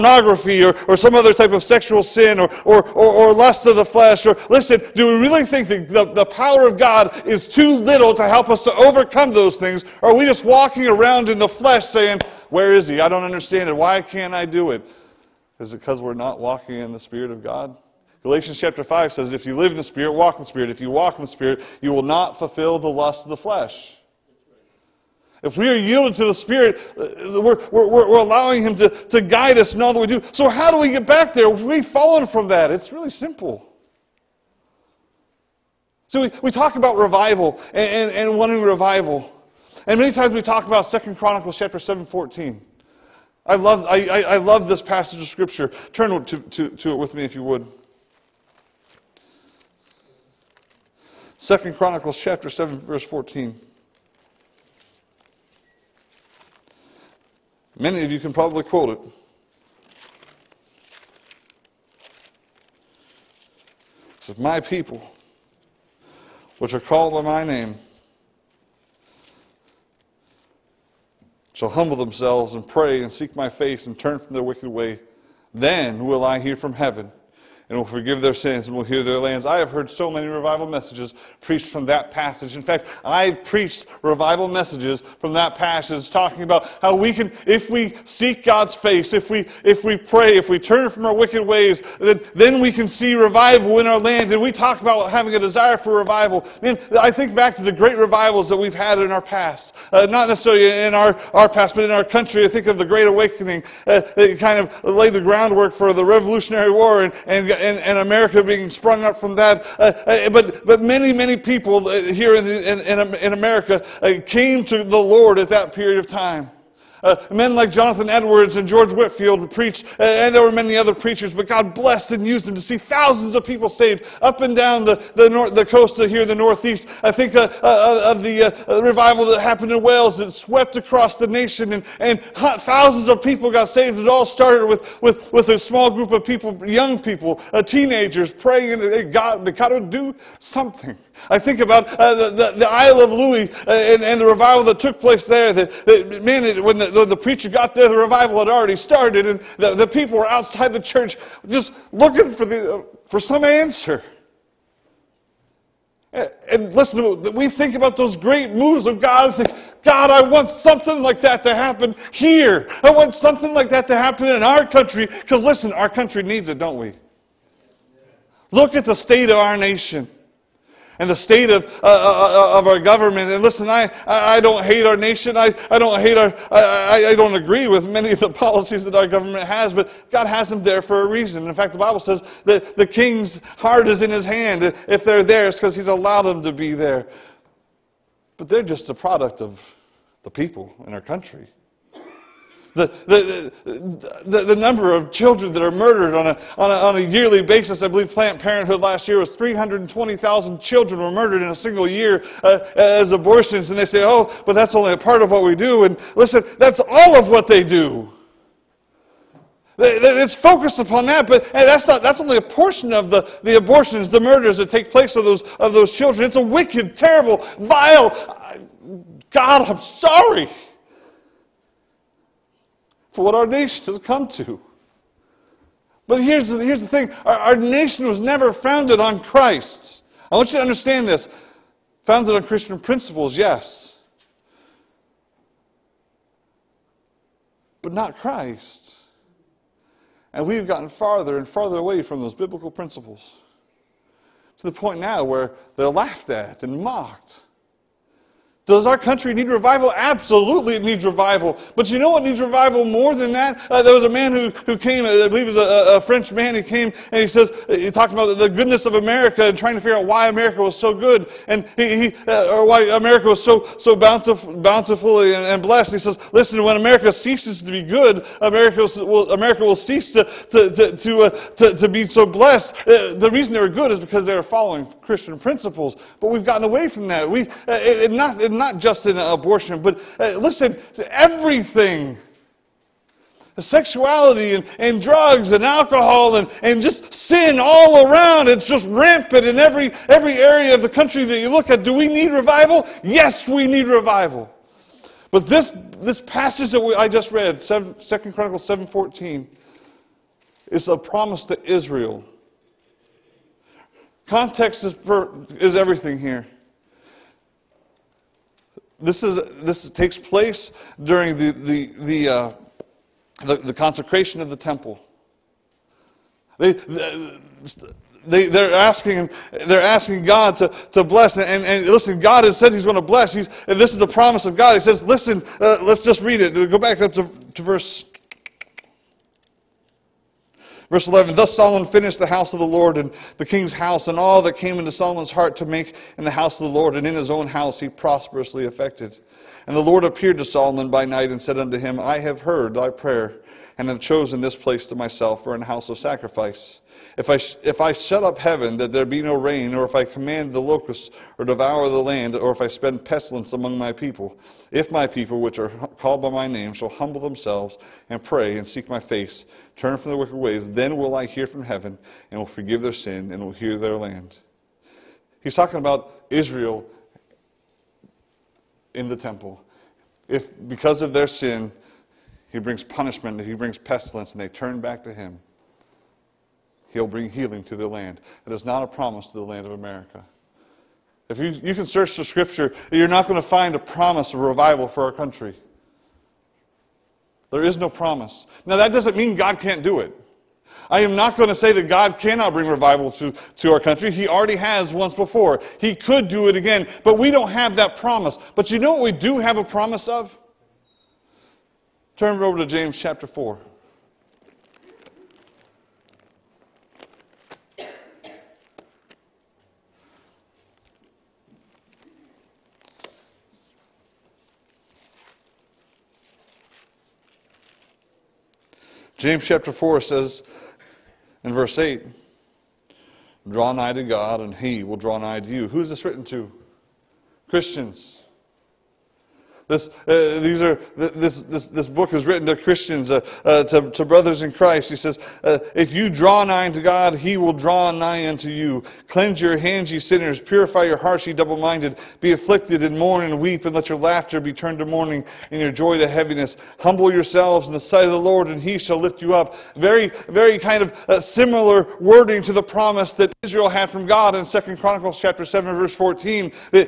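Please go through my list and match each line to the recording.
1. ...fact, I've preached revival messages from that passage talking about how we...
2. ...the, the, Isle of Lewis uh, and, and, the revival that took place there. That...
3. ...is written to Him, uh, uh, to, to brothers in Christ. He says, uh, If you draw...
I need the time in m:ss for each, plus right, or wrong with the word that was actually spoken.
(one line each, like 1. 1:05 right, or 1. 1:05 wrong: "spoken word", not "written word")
1. 1:22 right
2. 2:22 right
3. 7:12 wrong: "Christians", not "Him".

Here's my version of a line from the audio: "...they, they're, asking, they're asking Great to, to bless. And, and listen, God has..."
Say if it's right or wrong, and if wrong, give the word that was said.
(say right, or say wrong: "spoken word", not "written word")
wrong: "God", not "Great".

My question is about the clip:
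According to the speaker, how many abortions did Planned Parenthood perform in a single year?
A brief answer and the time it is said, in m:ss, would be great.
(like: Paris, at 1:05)
320,000, at 3:19.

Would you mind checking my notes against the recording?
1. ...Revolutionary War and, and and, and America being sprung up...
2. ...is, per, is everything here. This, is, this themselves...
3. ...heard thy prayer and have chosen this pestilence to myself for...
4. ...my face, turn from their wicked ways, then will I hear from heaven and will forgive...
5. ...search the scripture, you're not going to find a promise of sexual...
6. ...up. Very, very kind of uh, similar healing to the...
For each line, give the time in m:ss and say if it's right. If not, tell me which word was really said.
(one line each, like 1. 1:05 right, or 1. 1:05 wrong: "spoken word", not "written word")
1. 1:46 right
2. 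5:04 wrong: "takes", not "themselves"
3. 5:42 wrong: "place", not "pestilence"
4. 5:58 right
5. 6:21 wrong: "revival", not "sexual"
6. 7:29 wrong: "wording", not "healing".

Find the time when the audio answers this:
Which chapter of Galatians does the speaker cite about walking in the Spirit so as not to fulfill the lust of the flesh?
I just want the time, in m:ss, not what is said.
0:18.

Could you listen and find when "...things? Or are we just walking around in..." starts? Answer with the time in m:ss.
0:09.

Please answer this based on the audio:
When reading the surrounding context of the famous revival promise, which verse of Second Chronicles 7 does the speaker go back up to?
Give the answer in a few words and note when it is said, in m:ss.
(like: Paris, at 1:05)
Verse 11, at 5:30.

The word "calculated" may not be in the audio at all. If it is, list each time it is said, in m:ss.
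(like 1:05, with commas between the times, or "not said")
not said.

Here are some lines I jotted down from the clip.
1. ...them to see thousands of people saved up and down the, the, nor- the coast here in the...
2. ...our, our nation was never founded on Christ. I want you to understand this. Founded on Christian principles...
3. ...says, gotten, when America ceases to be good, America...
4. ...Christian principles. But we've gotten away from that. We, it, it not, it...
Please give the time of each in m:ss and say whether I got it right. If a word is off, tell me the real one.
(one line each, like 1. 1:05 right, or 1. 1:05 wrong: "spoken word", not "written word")
1. 2:02 right
2. 3:47 right
3. 4:25 wrong: "listen", not "gotten"
4. 4:35 right.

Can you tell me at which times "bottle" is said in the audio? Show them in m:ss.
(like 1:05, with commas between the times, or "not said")
not said.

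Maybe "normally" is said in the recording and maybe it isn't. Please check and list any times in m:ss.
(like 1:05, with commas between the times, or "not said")
not said.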